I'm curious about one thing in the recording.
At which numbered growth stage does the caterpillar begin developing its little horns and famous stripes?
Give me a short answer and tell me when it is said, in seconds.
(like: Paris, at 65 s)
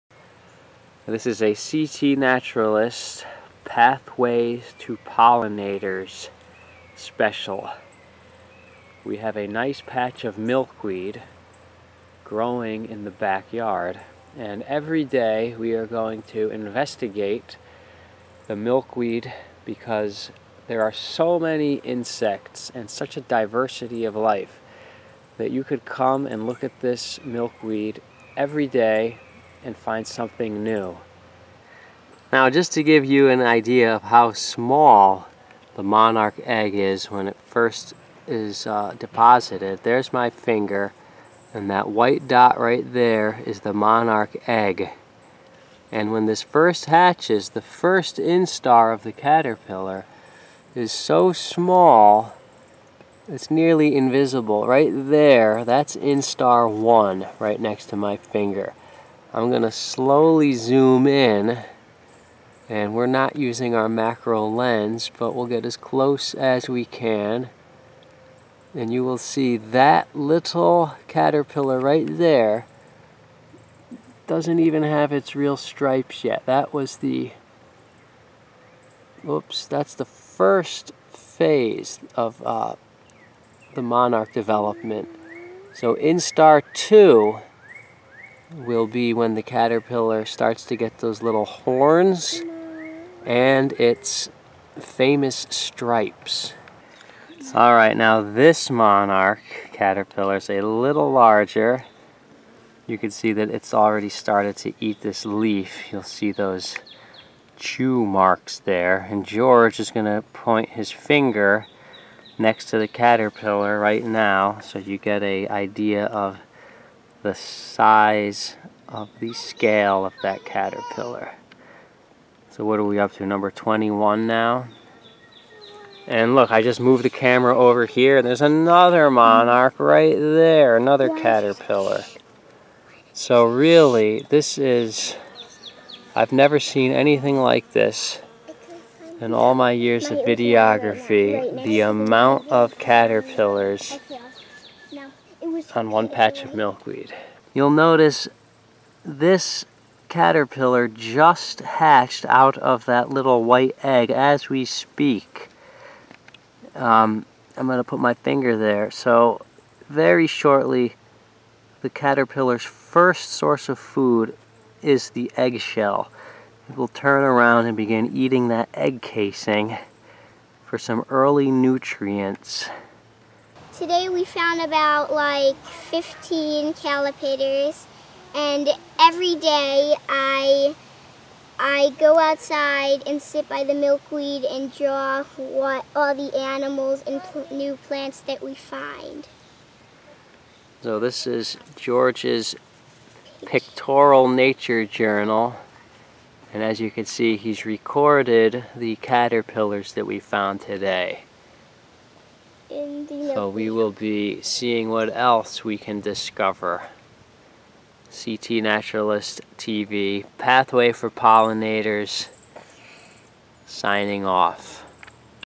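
Instar 2, at 85 s.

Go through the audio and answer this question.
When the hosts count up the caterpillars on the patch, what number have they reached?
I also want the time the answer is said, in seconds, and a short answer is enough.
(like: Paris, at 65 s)
21, at 123 s.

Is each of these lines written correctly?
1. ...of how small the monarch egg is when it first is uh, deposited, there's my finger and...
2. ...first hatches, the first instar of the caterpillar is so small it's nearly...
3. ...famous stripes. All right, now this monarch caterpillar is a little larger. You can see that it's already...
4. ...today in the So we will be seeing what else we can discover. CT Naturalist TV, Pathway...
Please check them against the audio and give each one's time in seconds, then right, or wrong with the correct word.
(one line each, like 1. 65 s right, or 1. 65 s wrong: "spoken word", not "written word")
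1. 33 s right
2. 46 s right
3. 94 s right
4. 200 s right.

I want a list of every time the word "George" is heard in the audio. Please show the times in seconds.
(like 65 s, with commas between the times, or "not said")
109 s, 191 s.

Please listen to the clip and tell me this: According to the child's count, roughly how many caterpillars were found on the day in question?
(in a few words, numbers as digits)
15.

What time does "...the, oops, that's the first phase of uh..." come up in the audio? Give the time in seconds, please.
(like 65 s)
76 s.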